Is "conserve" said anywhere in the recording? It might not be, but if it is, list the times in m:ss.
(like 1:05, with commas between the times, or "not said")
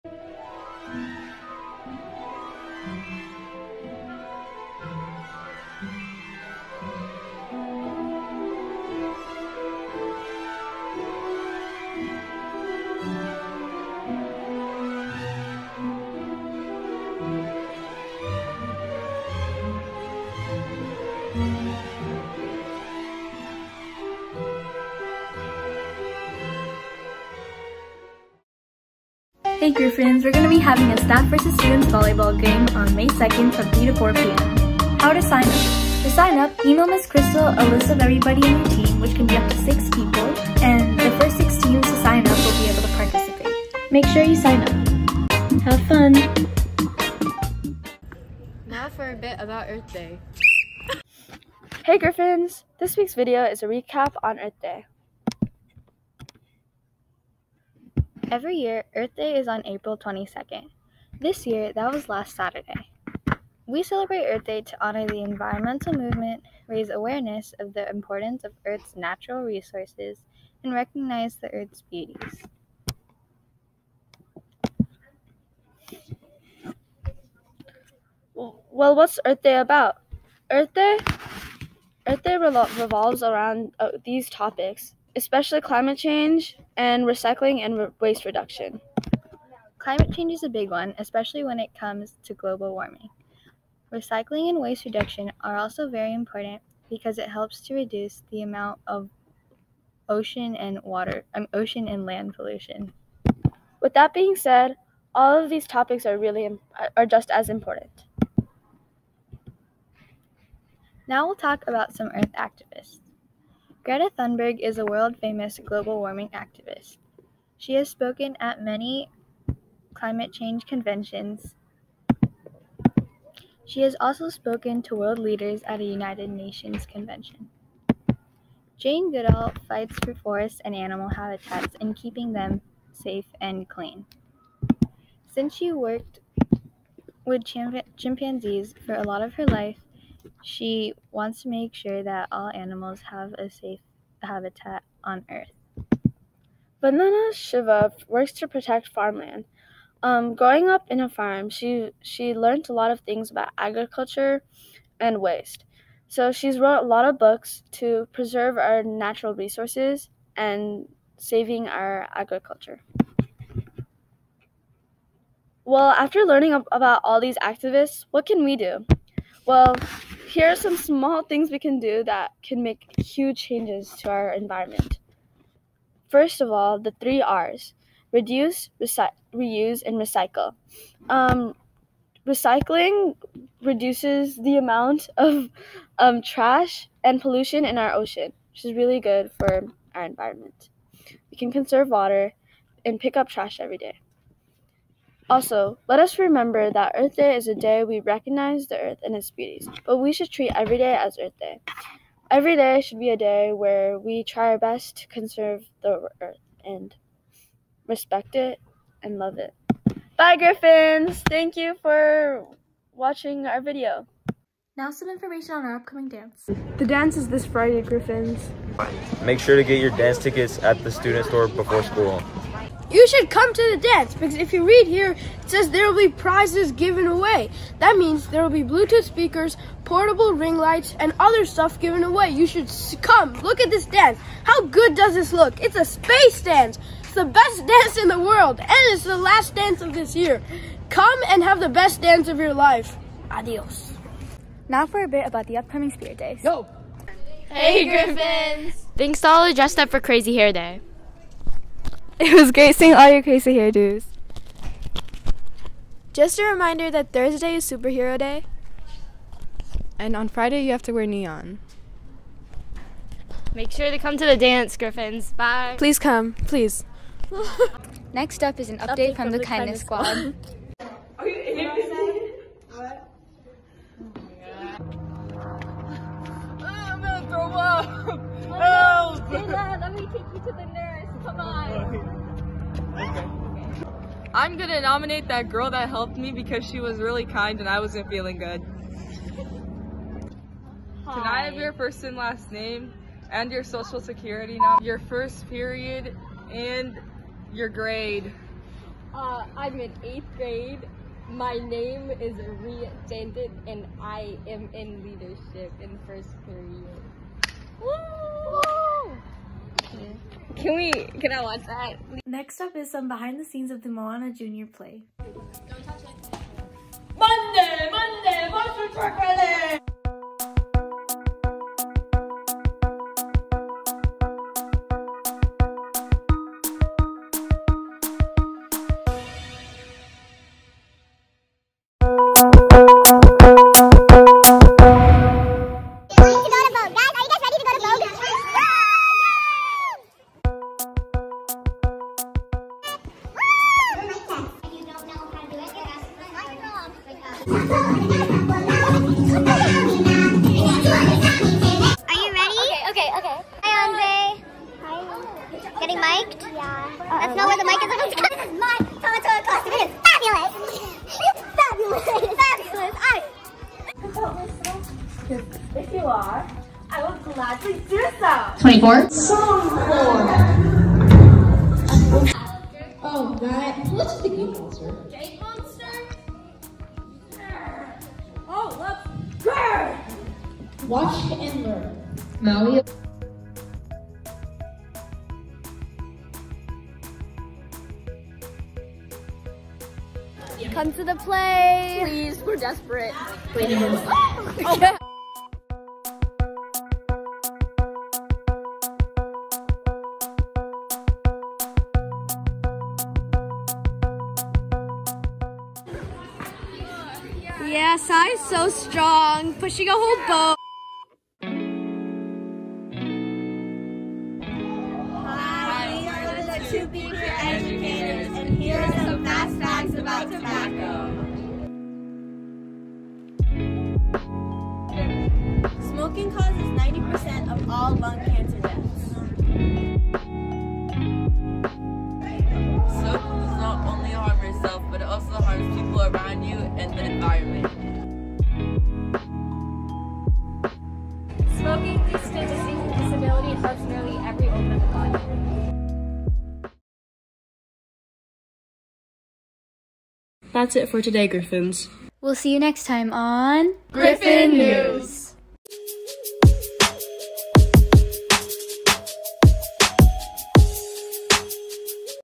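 3:11, 3:25.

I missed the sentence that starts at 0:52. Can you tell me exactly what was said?
This week's video is a recap on Earth Day.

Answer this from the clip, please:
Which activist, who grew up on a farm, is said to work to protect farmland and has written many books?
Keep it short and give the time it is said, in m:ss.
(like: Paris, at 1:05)
Vandana Shiva, at 2:26.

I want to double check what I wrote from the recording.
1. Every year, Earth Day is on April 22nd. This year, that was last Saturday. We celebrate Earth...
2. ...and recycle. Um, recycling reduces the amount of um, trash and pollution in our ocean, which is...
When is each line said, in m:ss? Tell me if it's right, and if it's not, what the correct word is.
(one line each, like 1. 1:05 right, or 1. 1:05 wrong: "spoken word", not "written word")
1. 0:58 right
2. 2:59 right.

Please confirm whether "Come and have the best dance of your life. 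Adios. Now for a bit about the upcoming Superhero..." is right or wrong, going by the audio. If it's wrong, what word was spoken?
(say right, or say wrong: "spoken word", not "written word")
wrong: "Spirit", not "Superhero".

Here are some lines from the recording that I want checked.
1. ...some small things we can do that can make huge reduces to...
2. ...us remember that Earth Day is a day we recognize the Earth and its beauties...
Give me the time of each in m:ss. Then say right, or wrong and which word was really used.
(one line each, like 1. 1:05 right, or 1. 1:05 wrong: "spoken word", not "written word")
1. 2:50 wrong: "changes", not "reduces"
2. 3:16 right.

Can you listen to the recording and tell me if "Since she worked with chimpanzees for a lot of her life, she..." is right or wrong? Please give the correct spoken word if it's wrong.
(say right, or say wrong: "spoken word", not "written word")
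right.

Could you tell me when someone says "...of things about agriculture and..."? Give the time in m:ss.
2:32.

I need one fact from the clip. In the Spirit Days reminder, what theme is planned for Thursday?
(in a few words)
Superhero Day.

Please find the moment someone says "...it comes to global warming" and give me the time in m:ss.
1:31.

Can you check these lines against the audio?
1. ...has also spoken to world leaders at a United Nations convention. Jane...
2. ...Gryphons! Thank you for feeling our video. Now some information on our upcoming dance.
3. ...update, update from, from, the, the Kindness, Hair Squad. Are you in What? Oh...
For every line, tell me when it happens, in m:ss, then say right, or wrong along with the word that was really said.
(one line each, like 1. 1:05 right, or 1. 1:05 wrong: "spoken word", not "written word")
1. 2:03 right
2. 3:30 wrong: "watching", not "feeling"
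3. 4:28 wrong: "Kindness", not "Hair".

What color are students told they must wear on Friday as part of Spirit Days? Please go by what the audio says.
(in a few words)
Neon.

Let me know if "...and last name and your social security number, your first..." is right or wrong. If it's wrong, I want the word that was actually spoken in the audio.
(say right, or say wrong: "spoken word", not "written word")
right.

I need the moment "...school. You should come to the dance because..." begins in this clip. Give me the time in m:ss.
3:41.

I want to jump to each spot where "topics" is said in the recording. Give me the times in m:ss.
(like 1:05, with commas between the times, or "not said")
1:24, 1:45.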